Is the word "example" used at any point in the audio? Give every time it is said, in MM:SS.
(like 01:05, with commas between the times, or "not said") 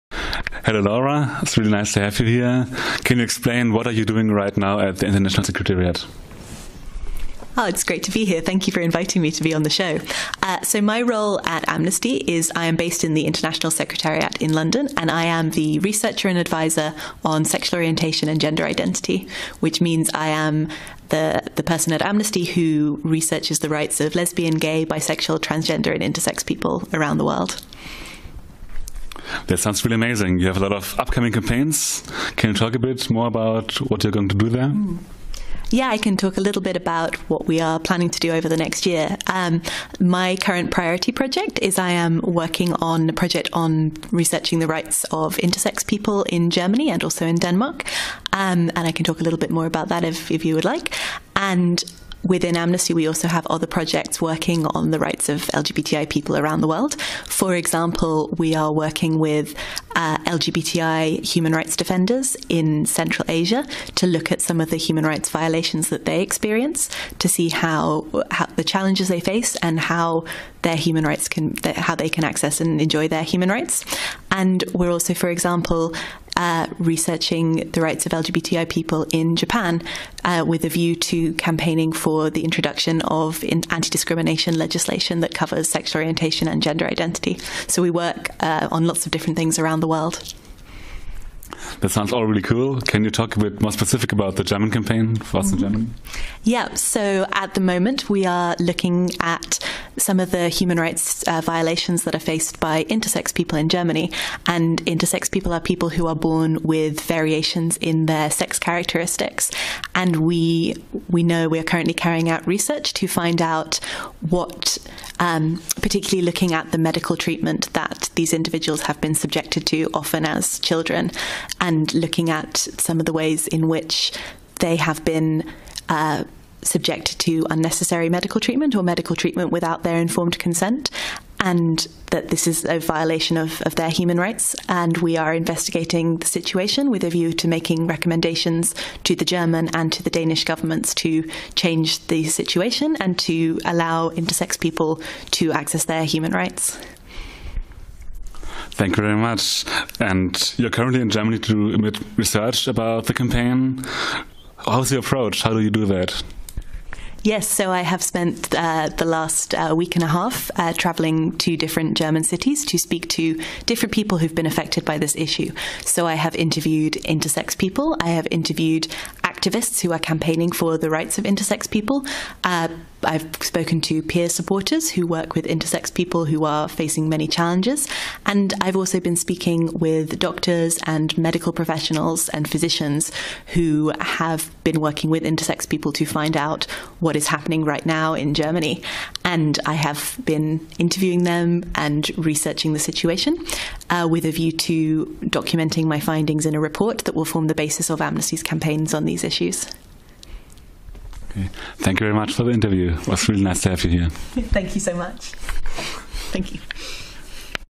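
00:57, 01:15.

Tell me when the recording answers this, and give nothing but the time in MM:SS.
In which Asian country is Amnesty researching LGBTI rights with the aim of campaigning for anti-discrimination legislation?
01:19.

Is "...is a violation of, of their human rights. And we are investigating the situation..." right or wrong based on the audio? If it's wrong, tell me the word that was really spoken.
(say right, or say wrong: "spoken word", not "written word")
right.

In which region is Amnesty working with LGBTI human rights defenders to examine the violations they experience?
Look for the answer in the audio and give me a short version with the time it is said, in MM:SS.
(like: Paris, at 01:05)
Central Asia, at 01:02.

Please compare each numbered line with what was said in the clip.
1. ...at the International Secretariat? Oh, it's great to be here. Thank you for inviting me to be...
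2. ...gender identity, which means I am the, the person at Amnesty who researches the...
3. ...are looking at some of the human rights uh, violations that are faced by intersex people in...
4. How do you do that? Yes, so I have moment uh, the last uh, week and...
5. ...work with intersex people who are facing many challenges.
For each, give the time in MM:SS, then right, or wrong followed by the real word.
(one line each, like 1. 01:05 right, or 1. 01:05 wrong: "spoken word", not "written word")
1. 00:04 right
2. 00:18 right
3. 01:38 right
4. 02:35 wrong: "spent", not "moment"
5. 02:55 right.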